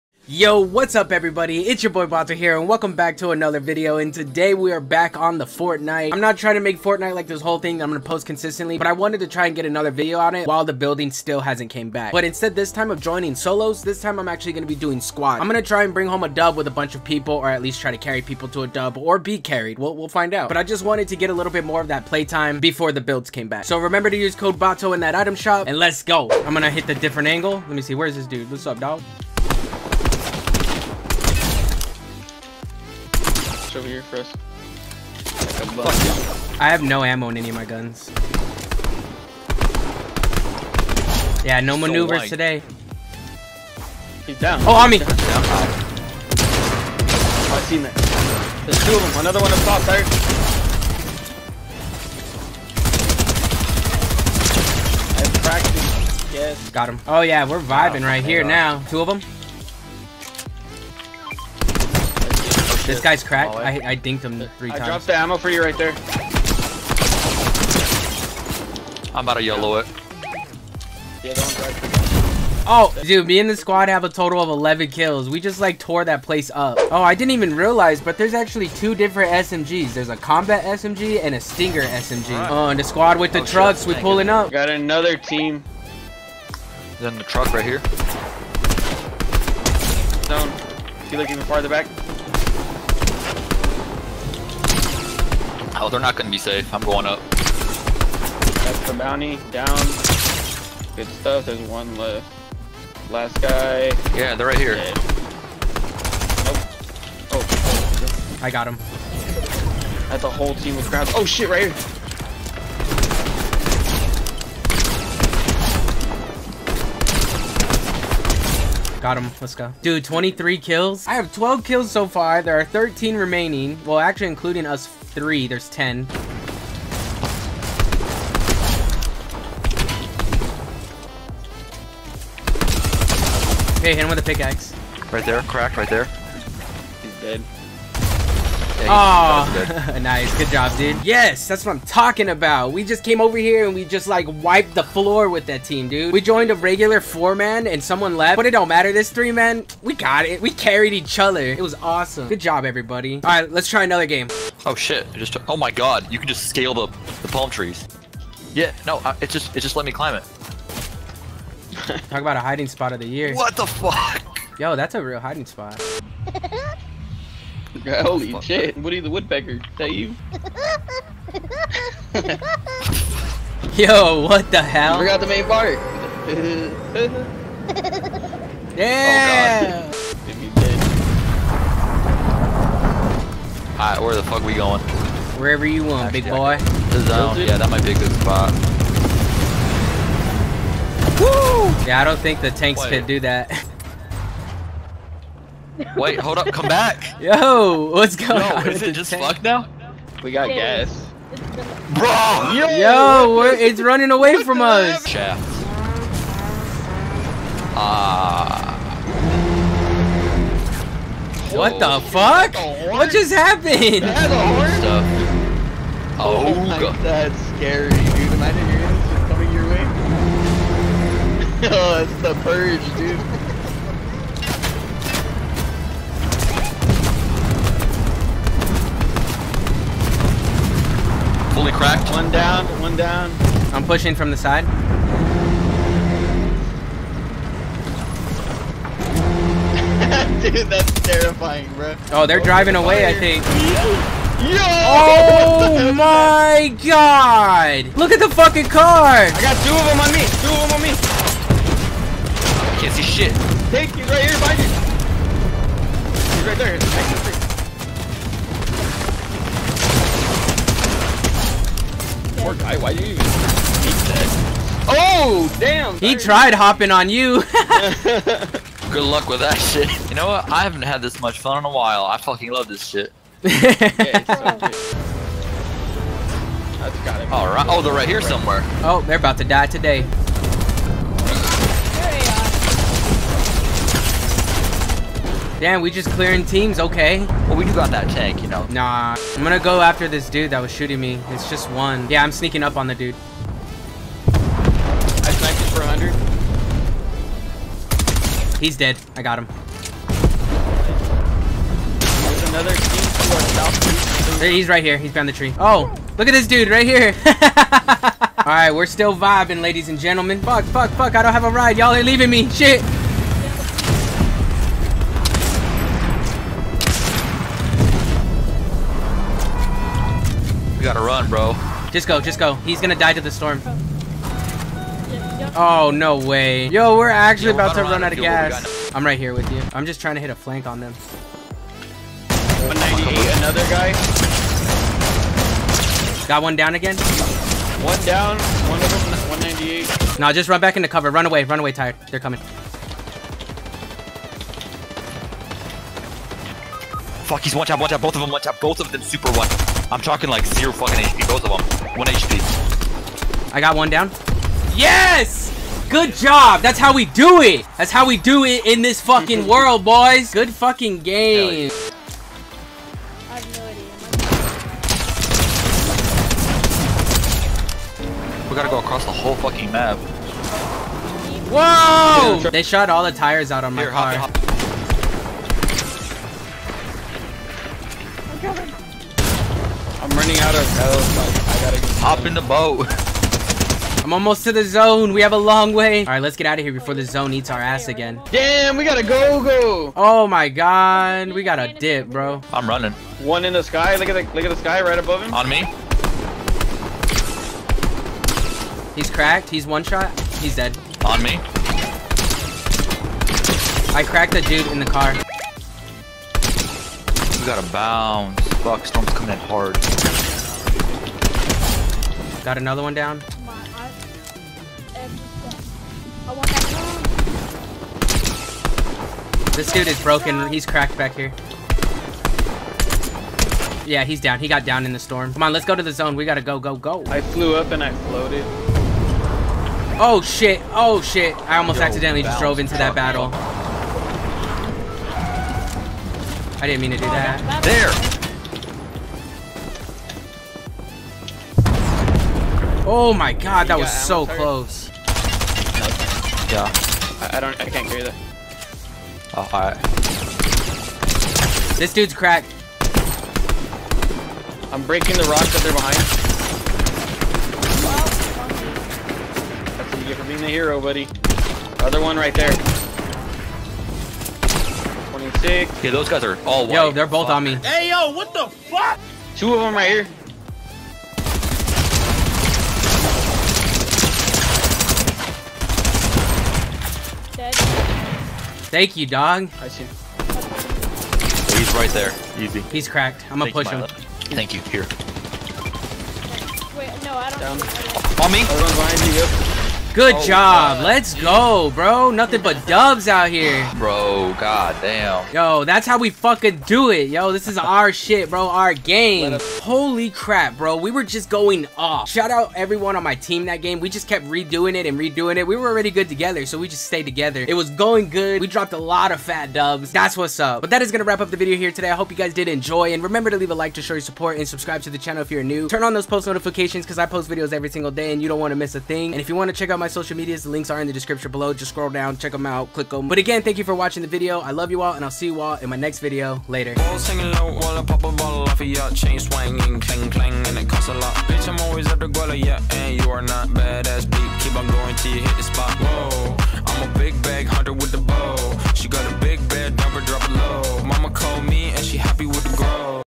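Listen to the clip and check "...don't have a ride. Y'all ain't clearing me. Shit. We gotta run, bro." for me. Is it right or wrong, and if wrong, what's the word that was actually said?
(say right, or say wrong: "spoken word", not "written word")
wrong: "leaving", not "clearing".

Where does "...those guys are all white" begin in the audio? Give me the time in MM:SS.
07:45.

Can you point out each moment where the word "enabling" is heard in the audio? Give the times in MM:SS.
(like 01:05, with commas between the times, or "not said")
not said.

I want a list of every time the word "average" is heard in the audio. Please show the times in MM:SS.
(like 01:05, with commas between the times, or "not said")
not said.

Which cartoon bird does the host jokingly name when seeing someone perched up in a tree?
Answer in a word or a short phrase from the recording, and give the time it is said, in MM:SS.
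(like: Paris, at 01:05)
Woody the Woodpecker, at 02:48.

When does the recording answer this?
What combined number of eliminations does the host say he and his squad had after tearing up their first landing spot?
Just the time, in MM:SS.
01:14.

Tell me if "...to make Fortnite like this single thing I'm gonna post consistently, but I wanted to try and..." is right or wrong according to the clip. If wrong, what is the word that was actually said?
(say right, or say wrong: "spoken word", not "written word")
wrong: "whole", not "single".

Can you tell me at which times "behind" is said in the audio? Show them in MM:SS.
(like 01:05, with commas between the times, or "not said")
04:14, 05:05, 07:35, 08:08.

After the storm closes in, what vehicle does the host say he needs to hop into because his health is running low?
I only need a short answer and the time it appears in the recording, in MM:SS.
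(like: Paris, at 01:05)
the boat, at 06:21.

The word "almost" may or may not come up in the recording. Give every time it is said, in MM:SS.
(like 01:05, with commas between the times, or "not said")
06:24, 07:11.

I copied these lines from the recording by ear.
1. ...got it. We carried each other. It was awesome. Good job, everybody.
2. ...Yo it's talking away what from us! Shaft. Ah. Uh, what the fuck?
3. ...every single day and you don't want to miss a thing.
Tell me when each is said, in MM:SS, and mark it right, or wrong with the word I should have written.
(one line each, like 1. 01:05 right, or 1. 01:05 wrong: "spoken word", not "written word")
1. 02:29 right
2. 03:22 wrong: "running", not "talking"
3. 08:37 right.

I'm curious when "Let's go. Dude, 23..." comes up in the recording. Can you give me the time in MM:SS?
01:59.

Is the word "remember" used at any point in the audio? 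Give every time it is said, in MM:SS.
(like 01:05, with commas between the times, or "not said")
00:23, 08:33.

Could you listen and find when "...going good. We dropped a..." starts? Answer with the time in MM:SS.
08:27.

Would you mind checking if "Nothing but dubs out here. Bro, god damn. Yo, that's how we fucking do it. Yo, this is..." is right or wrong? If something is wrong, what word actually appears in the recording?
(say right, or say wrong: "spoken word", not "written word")
right.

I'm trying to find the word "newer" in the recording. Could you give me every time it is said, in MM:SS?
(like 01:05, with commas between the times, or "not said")
not said.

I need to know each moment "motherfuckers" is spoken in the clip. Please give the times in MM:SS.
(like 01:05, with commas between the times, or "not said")
not said.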